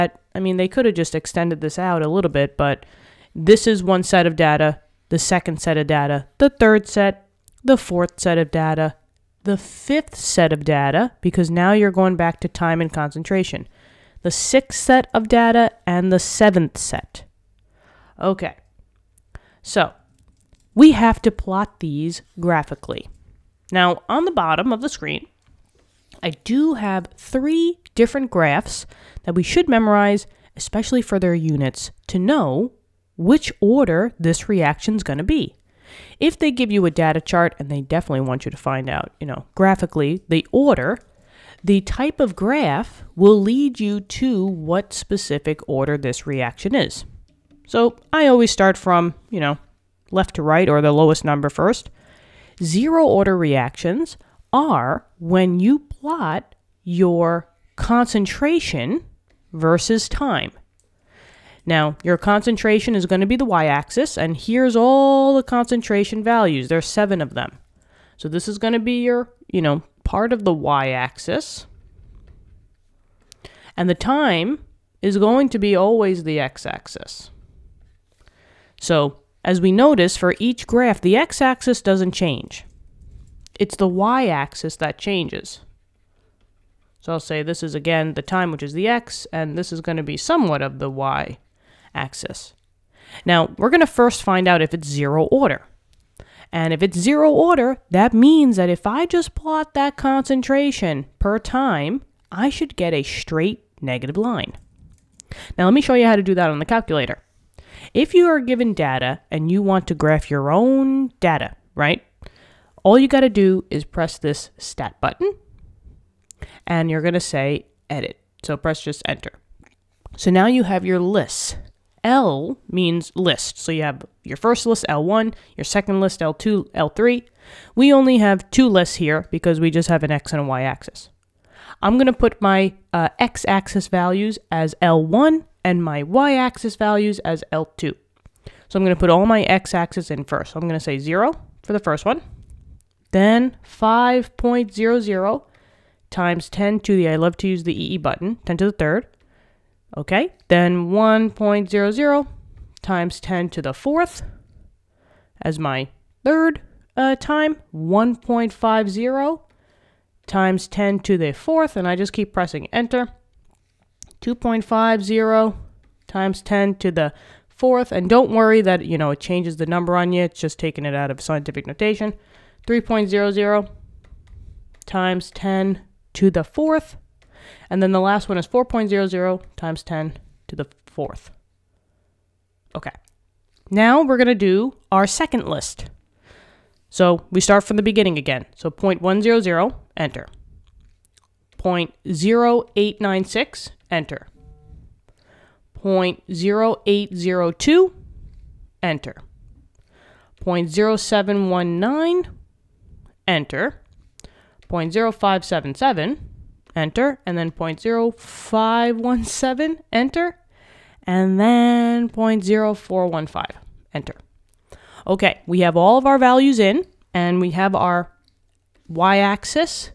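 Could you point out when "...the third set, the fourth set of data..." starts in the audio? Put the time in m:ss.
0:06.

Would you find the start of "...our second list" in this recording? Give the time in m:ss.
3:04.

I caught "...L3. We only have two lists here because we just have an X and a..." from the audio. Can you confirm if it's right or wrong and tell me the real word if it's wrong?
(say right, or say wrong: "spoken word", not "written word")
right.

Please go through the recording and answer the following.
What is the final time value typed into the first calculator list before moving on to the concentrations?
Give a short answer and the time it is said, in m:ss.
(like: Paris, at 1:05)
4.00 x 10^4, at 2:58.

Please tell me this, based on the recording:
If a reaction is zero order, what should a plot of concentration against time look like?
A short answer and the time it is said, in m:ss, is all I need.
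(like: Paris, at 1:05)
a straight negative line, at 1:42.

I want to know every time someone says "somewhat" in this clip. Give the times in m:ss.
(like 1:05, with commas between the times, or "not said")
1:30.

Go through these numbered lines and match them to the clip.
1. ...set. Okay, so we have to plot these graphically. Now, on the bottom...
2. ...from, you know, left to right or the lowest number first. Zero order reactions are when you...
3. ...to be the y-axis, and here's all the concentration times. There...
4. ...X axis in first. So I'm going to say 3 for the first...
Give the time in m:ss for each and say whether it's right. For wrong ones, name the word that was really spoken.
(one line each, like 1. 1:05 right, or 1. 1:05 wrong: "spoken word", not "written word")
1. 0:16 right
2. 0:48 right
3. 1:03 wrong: "values", not "times"
4. 2:19 wrong: "0", not "3".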